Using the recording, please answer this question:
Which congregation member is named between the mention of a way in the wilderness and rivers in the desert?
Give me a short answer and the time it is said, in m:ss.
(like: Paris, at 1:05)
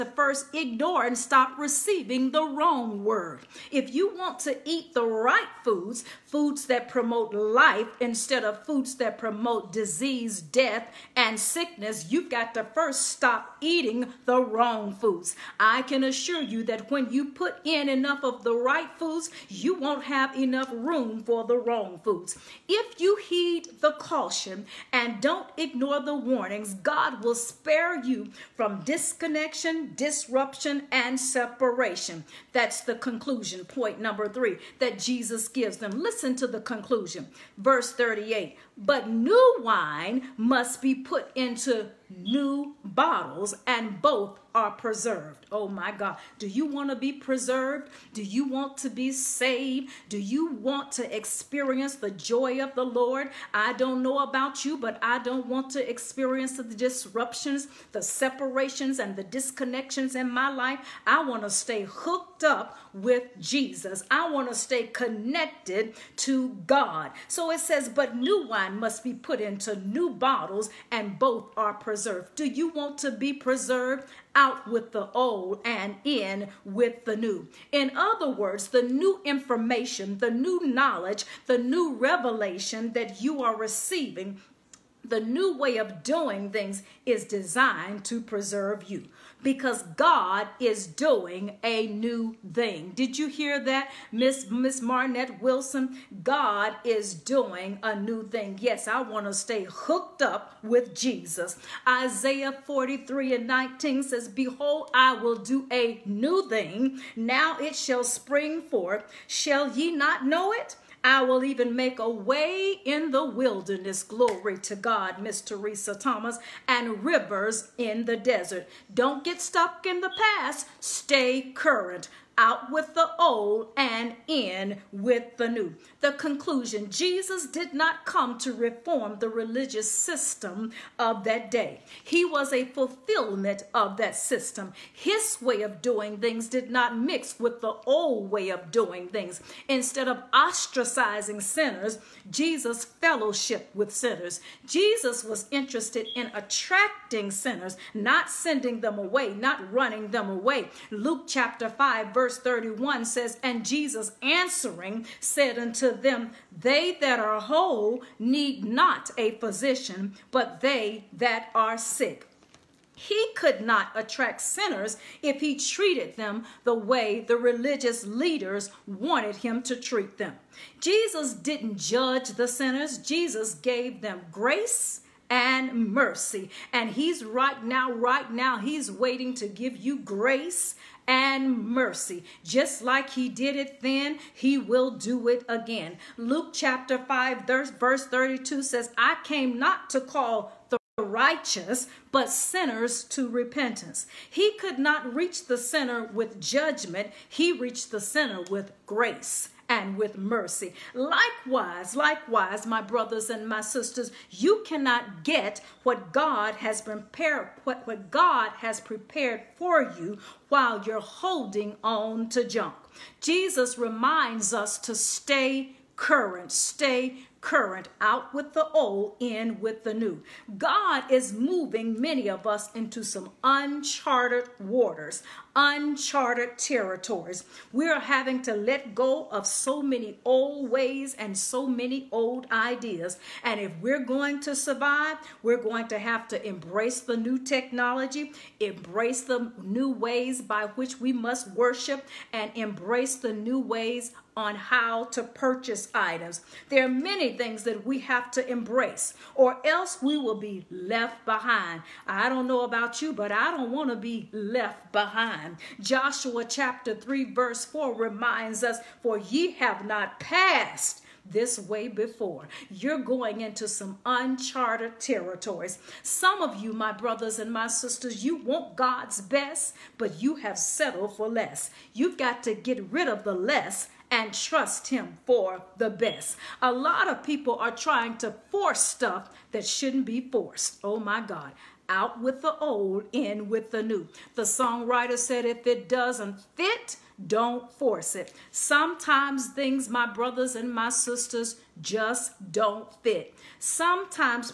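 Teresa Thomas, at 1:55.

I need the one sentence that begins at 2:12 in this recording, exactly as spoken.
He was a fulfillment of that system.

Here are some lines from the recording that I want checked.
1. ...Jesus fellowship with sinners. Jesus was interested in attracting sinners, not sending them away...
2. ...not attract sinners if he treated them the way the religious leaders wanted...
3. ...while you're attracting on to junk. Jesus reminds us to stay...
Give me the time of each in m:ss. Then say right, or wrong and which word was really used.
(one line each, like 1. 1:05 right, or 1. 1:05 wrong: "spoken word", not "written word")
1. 2:22 right
2. 2:43 right
3. 3:30 wrong: "holding", not "attracting".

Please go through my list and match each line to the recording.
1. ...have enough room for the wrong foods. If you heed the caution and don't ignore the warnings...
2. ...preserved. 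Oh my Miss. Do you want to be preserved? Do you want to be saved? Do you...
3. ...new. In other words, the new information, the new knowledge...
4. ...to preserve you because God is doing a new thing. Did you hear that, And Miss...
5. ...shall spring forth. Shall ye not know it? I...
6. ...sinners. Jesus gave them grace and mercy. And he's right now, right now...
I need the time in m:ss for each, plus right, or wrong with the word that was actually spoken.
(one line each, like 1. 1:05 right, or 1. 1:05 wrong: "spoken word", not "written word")
1. 0:20 right
2. 0:44 wrong: "God", not "Miss"
3. 1:17 right
4. 1:28 wrong: "Miss", not "And"
5. 1:47 right
6. 2:52 right.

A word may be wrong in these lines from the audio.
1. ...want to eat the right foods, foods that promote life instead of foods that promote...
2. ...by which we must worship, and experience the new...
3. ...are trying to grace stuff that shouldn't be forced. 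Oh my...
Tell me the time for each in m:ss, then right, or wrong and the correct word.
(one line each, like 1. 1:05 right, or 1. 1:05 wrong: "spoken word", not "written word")
1. 0:04 right
2. 4:00 wrong: "embrace", not "experience"
3. 4:37 wrong: "force", not "grace".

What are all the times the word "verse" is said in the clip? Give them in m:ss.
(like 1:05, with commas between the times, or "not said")
0:37, 2:32, 3:07, 4:17.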